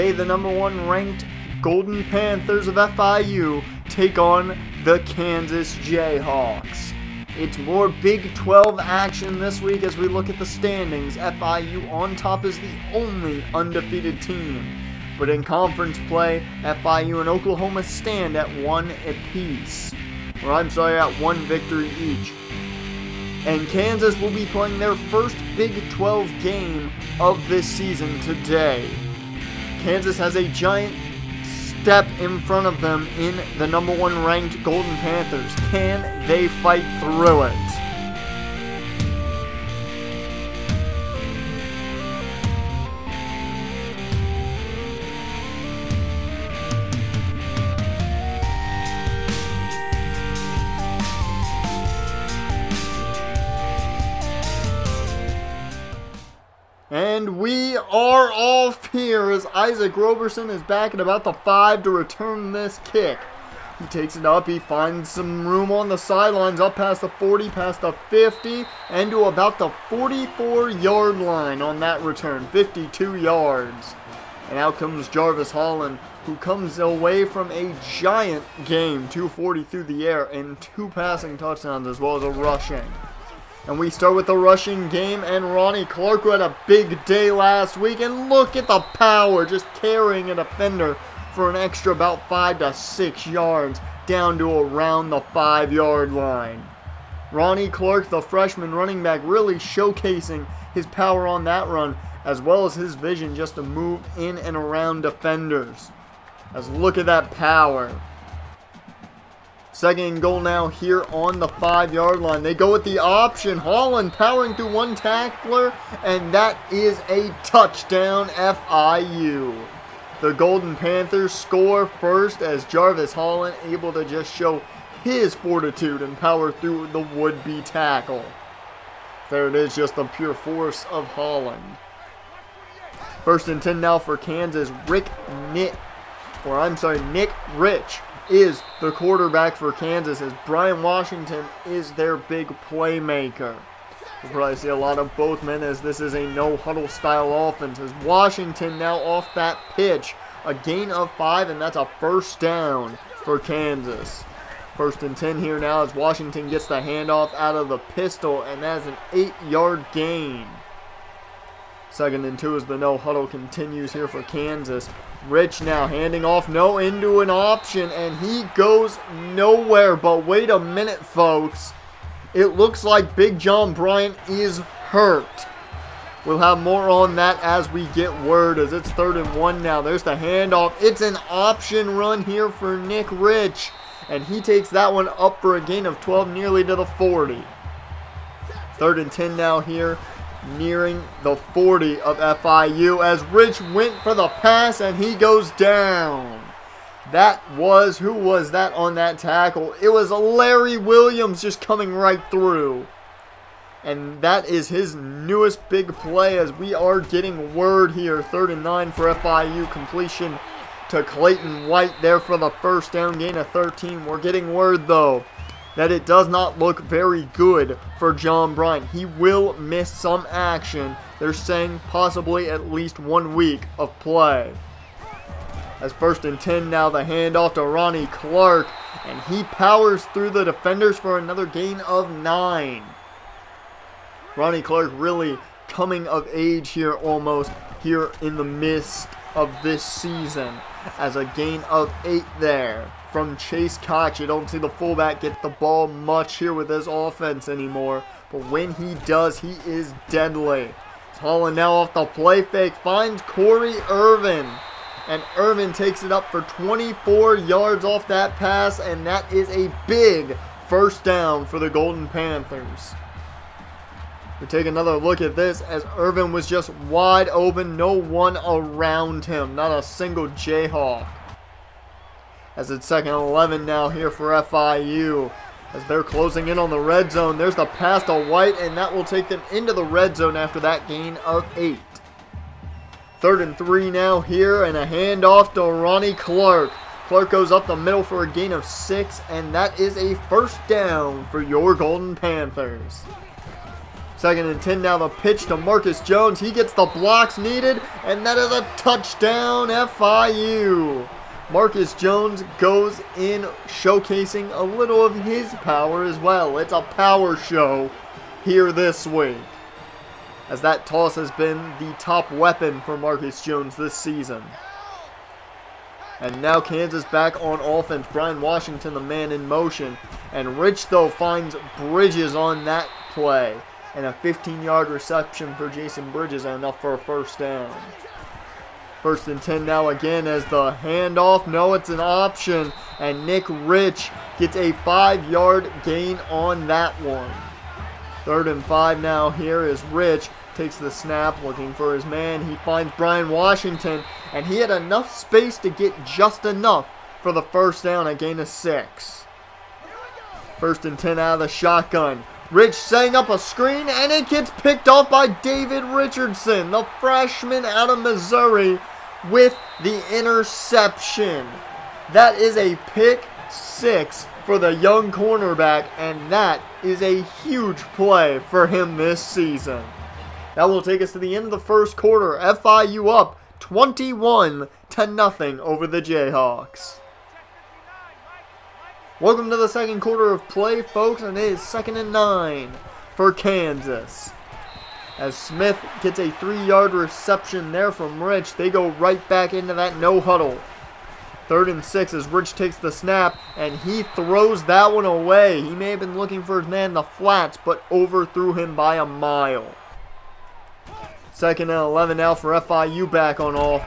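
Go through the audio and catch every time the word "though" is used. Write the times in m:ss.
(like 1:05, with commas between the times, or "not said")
3:34, 5:20.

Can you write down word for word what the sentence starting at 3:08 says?
Third and 10 now here nearing the 40 of FIU as Rich went for the pass and he goes down.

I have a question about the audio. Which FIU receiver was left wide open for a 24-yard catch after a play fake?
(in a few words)
Corey Irvin.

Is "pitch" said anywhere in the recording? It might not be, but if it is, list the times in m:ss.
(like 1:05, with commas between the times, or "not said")
2:29, 4:55.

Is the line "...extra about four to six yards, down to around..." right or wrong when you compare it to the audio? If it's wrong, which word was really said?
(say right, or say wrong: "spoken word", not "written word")
wrong: "five", not "four".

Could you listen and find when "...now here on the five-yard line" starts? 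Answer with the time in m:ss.
1:50.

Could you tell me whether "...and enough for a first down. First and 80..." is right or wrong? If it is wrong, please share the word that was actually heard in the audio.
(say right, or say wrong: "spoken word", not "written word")
wrong: "10", not "80".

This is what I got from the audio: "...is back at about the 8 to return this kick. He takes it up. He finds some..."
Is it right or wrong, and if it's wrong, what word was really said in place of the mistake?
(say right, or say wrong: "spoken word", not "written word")
wrong: "5", not "8".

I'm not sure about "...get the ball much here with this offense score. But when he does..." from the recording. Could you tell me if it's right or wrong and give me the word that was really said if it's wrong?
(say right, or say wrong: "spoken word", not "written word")
wrong: "anymore", not "score".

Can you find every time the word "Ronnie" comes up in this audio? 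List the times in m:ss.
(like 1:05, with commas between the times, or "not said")
1:25, 1:37, 3:47, 3:54, 4:45.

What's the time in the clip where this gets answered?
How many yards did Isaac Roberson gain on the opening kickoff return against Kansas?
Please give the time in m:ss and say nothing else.
1:12.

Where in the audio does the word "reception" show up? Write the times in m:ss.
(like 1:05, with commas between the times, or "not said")
5:24, 6:26.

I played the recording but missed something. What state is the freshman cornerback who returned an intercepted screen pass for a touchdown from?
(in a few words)
Missouri.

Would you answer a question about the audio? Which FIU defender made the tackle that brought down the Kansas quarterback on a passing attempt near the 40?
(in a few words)
Larry Williams.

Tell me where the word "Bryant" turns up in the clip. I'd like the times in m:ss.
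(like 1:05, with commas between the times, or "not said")
2:53, 3:38.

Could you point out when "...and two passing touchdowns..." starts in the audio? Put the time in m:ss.
1:20.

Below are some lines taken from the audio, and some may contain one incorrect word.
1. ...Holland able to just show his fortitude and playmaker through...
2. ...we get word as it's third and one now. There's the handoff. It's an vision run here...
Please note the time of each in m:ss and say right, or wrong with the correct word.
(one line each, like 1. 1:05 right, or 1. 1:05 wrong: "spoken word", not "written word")
1. 2:03 wrong: "power", not "playmaker"
2. 2:57 wrong: "option", not "vision".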